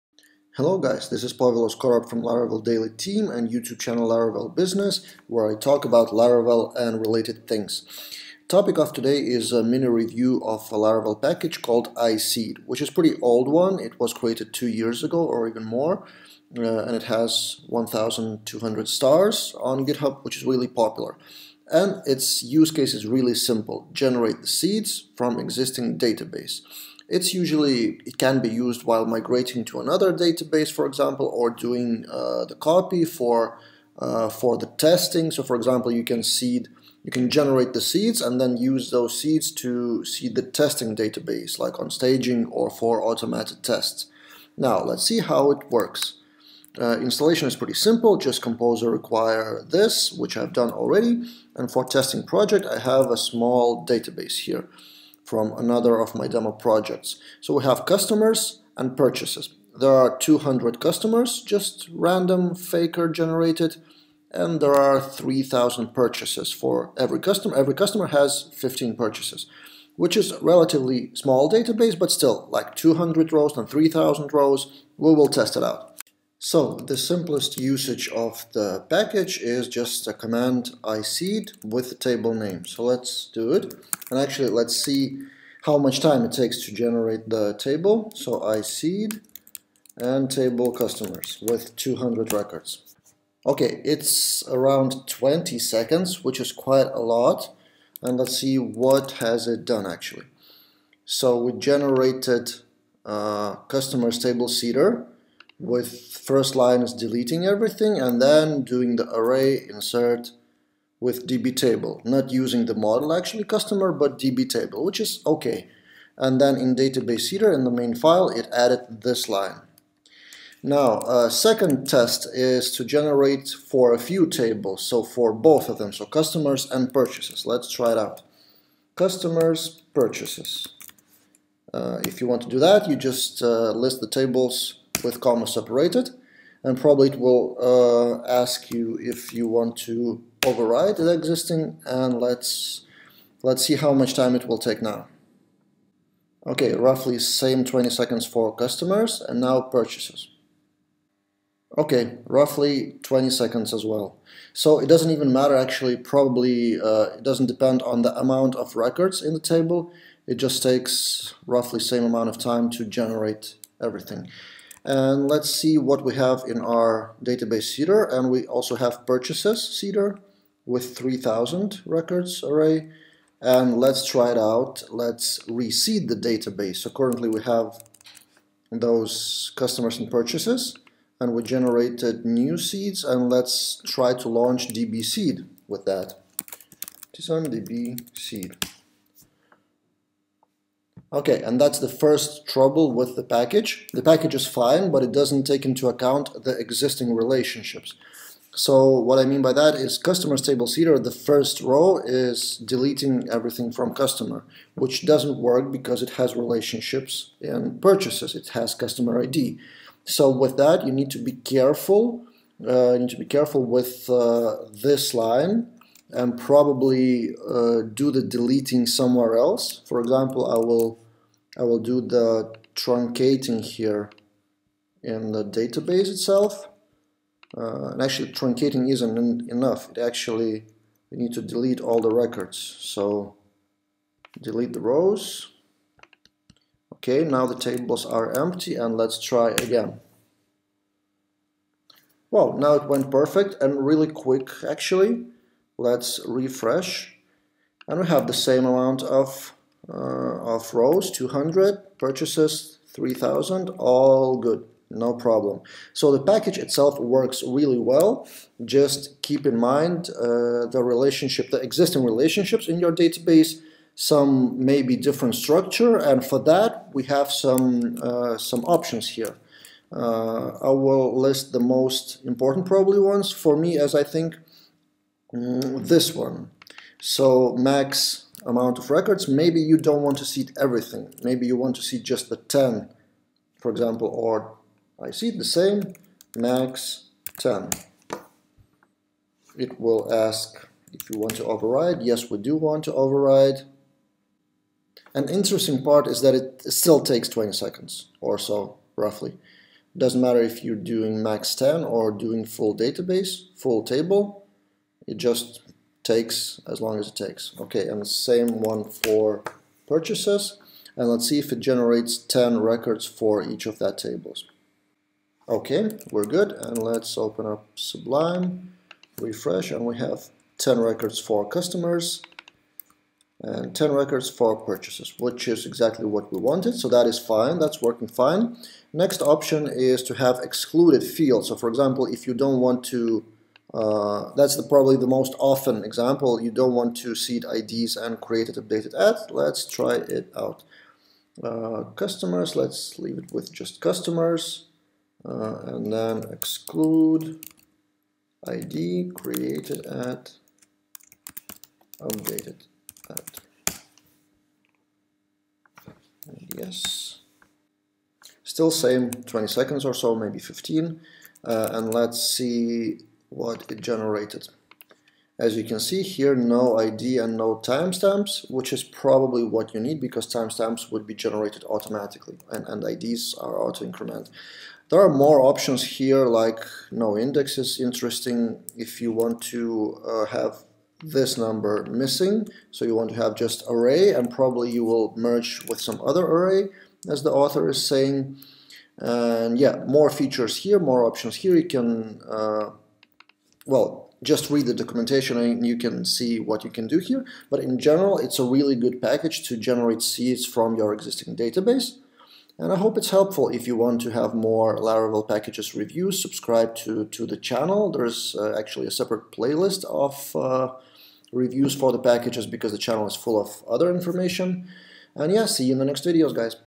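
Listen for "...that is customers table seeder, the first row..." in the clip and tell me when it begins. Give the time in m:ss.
3:19.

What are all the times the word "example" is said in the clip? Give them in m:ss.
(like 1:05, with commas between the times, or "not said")
0:30, 0:35, 3:39, 4:43, 5:31, 5:35.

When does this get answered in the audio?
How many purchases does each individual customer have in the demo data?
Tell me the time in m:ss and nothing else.
1:07.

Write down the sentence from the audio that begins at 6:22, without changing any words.
So you want to have just array and probably you will merge with some other array as the author is saying.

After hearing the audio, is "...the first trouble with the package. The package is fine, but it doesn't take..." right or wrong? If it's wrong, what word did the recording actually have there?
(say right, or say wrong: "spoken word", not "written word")
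right.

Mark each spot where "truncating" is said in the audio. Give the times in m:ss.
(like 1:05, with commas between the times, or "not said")
3:42, 3:48.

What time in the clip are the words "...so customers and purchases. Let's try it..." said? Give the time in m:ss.
2:05.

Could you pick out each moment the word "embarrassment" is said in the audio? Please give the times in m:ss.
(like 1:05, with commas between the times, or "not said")
not said.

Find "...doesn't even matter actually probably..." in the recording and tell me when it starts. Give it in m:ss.
2:34.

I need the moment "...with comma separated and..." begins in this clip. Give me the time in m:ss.
2:15.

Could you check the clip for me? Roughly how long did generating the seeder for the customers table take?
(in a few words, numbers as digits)
20 seconds.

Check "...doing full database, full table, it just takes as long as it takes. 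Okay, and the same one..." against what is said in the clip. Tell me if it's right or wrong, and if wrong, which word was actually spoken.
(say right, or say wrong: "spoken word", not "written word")
right.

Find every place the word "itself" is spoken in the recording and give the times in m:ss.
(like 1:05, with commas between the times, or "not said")
3:46, 4:16.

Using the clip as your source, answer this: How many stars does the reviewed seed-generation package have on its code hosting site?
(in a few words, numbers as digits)
1,200.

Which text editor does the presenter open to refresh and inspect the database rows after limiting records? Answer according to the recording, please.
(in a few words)
Sublime.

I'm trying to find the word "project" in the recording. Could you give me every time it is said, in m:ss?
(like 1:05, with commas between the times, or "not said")
0:52, 0:56.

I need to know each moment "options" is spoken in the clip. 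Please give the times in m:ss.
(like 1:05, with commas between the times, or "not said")
4:28, 5:29, 6:15, 6:31.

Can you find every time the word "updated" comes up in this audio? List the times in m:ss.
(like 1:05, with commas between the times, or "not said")
5:38, 5:52.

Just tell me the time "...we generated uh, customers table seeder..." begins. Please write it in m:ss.
1:41.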